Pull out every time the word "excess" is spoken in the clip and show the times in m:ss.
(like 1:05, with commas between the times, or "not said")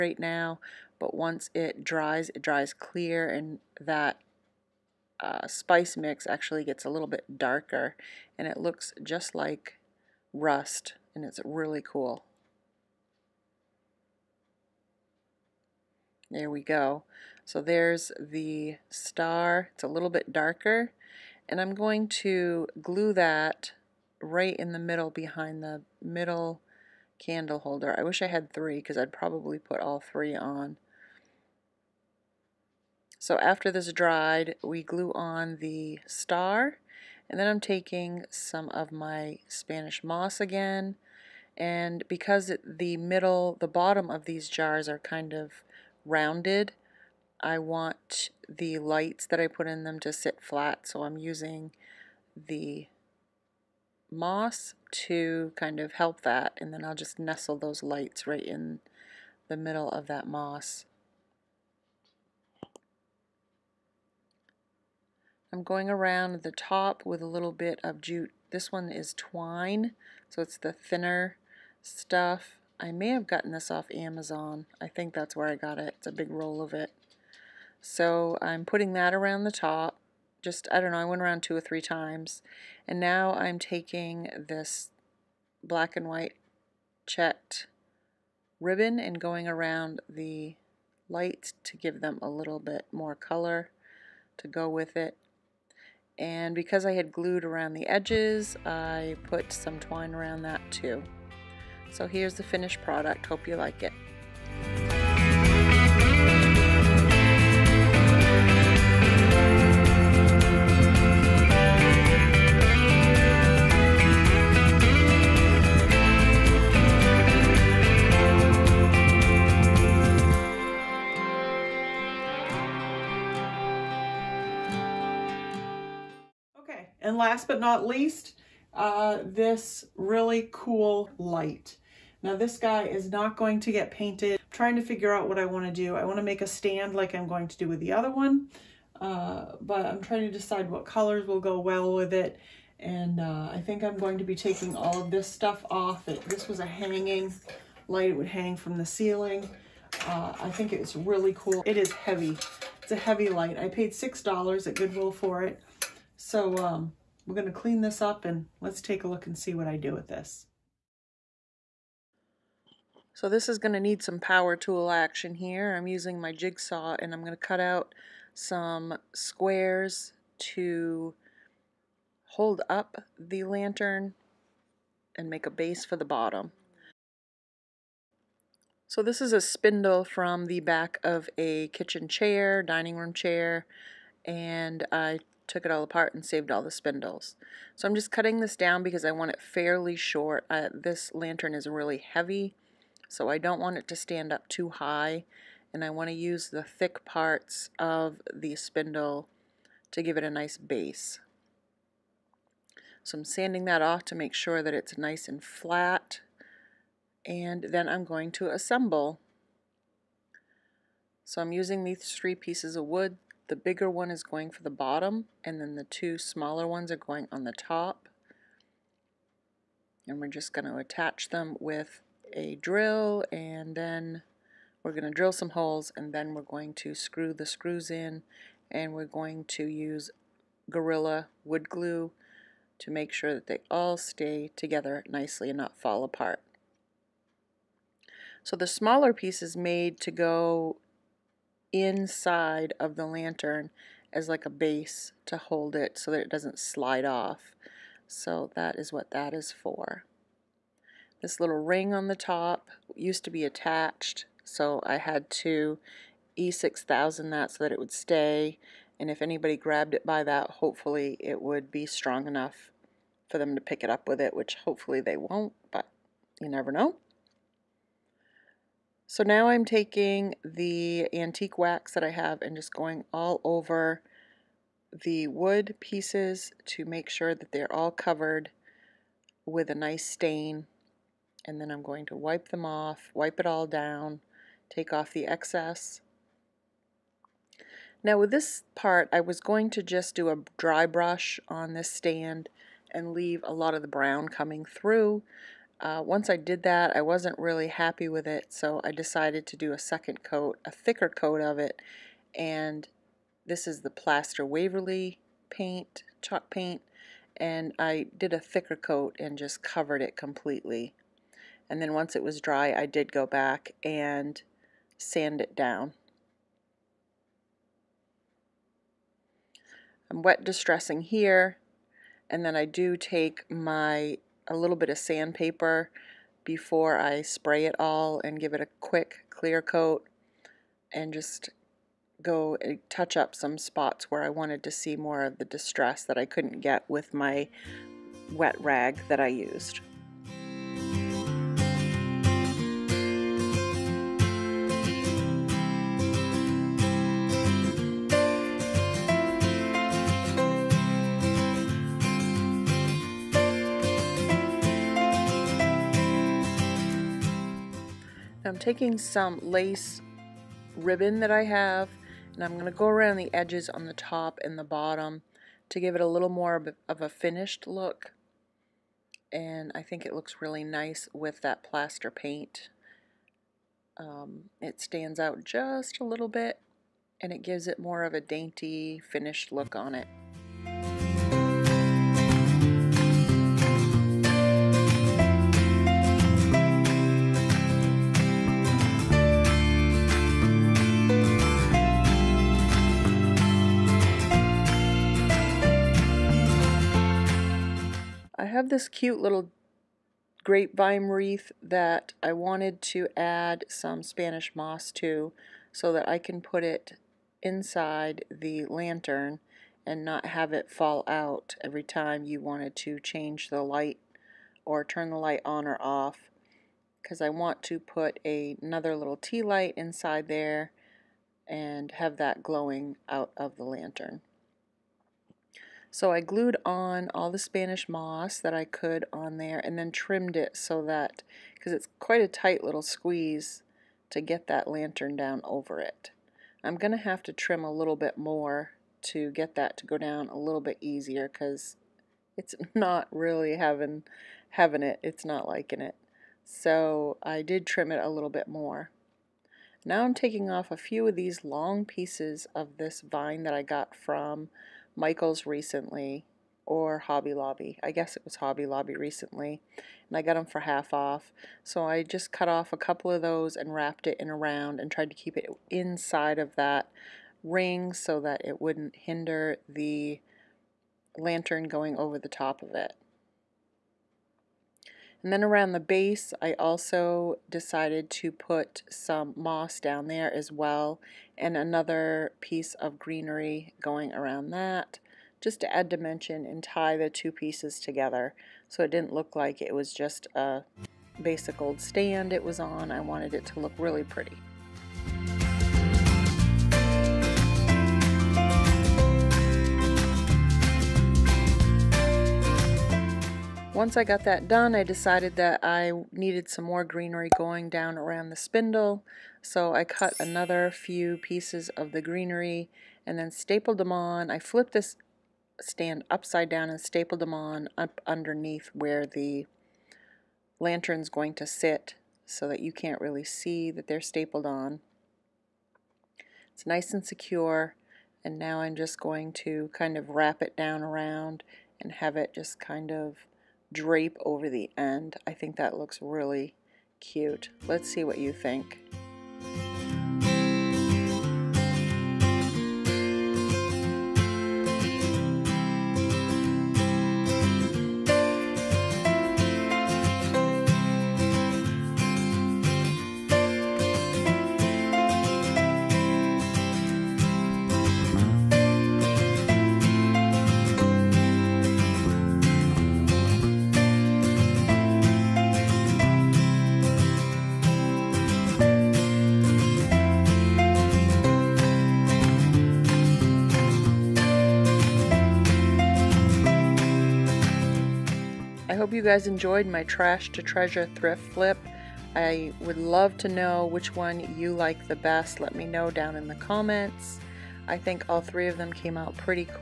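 4:45.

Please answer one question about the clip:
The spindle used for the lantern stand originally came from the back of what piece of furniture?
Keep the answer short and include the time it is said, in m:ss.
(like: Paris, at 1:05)
kitchen chair, at 3:01.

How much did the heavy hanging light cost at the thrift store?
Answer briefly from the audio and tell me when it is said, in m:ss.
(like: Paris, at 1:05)
$6, at 2:33.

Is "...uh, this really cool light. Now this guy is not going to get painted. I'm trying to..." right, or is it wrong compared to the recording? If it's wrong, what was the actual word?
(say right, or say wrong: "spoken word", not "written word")
right.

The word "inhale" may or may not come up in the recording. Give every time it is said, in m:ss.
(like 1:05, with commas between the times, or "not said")
not said.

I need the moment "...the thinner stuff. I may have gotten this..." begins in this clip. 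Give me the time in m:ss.
1:10.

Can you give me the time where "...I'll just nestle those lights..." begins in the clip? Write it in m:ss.
0:56.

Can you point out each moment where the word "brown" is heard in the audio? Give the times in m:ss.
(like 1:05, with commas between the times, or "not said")
4:53.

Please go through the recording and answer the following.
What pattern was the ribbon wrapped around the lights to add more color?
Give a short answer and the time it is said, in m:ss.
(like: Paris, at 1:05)
black and white checked, at 1:25.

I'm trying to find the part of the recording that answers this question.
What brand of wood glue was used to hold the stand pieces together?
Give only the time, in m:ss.
3:50.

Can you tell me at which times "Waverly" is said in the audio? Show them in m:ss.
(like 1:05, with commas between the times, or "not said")
5:04.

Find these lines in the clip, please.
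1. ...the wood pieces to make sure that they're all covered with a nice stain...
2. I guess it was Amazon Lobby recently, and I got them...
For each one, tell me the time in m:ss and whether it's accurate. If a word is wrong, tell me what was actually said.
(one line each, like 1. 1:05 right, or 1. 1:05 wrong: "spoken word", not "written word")
1. 4:34 right
2. 7:37 wrong: "Hobby", not "Amazon".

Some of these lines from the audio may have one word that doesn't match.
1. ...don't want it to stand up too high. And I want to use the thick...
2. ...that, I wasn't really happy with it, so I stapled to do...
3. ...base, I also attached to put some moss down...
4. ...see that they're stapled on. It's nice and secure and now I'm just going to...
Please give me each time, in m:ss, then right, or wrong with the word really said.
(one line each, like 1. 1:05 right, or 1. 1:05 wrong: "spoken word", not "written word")
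1. 3:13 right
2. 4:56 wrong: "decided", not "stapled"
3. 7:55 wrong: "decided", not "attached"
4. 8:43 right.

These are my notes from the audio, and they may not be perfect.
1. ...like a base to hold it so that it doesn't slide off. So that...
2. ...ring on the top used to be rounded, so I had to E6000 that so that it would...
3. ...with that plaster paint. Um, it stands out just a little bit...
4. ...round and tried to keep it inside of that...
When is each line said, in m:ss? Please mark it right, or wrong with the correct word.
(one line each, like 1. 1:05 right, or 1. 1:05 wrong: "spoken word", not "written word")
1. 4:04 right
2. 4:11 wrong: "attached", not "rounded"
3. 6:11 right
4. 7:44 right.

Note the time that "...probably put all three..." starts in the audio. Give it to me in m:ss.
0:29.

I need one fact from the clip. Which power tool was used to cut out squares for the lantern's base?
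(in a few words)
jigsaw.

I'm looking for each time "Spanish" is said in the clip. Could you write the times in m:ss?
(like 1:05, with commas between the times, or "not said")
0:39, 6:44, 7:07.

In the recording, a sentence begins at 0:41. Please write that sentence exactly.
And because the middle, the bottom of these jars are kind of rounded.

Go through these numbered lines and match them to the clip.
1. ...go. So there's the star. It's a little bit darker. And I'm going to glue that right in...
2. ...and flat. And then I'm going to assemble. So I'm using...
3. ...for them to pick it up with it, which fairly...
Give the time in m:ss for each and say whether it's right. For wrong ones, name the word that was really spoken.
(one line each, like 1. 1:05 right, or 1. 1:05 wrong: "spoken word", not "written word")
1. 0:16 right
2. 3:25 right
3. 4:23 wrong: "hopefully", not "fairly".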